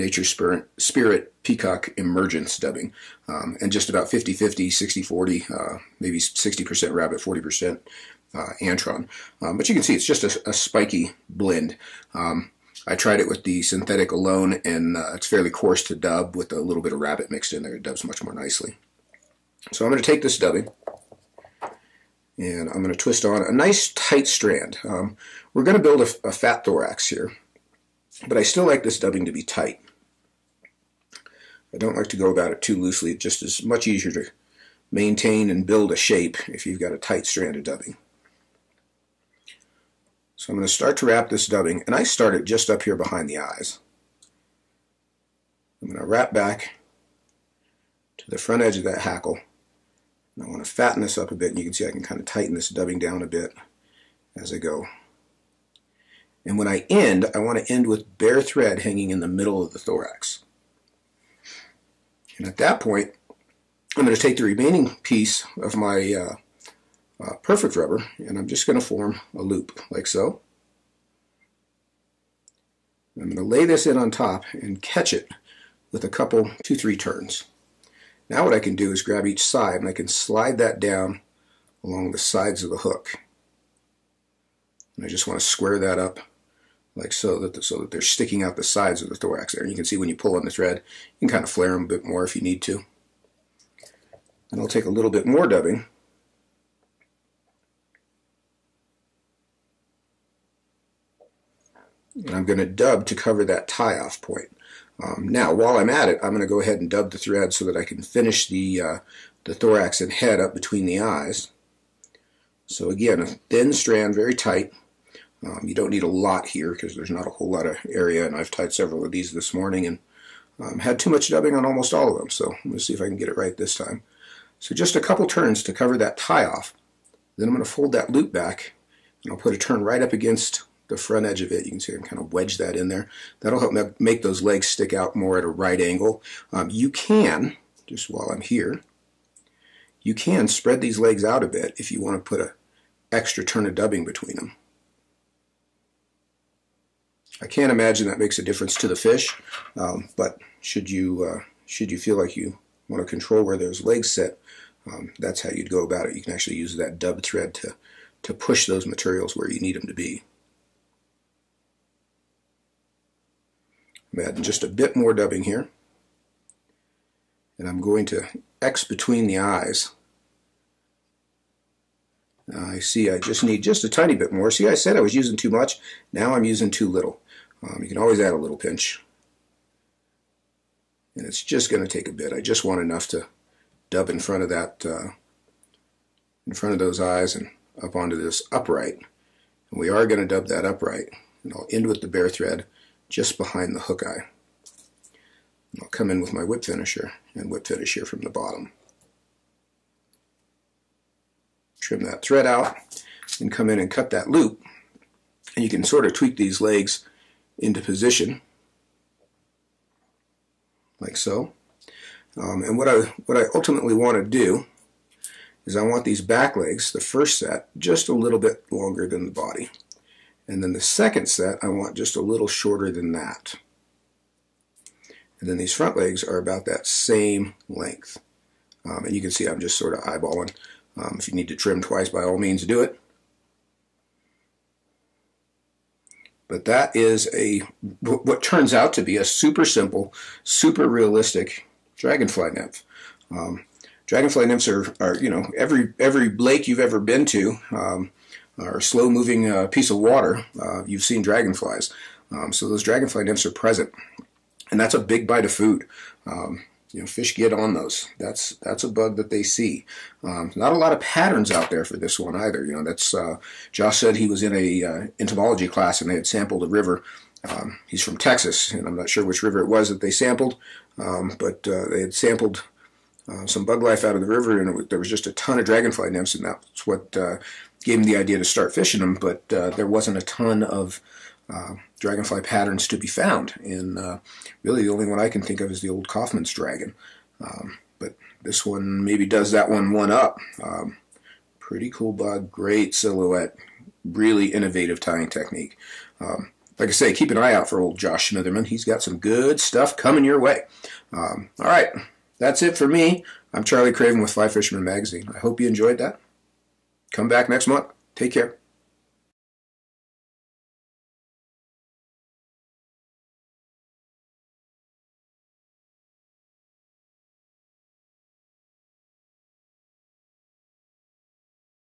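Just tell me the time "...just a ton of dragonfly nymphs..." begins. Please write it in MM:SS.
04:35.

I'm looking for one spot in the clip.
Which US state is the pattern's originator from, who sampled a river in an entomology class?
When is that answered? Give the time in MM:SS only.
04:28.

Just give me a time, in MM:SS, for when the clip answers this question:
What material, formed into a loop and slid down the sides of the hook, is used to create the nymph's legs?
01:07.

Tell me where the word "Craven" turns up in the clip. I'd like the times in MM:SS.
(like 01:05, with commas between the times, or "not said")
05:03.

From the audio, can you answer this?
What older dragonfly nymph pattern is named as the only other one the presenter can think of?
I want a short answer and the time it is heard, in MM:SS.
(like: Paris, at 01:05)
Kaufmann's dragon, at 04:46.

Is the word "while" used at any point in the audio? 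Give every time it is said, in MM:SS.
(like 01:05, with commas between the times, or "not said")
01:45, 02:18.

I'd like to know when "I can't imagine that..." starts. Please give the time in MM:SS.
02:27.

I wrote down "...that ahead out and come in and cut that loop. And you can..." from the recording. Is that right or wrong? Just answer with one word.
wrong.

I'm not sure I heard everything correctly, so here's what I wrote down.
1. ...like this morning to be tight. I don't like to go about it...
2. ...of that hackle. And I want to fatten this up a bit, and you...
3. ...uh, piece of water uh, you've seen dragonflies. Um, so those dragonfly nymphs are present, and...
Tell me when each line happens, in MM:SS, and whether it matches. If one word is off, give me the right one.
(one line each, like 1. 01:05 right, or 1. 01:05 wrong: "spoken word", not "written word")
1. 00:28 wrong: "dubbing", not "morning"
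2. 00:48 right
3. 04:09 right.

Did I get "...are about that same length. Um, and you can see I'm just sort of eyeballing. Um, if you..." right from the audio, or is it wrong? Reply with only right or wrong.
right.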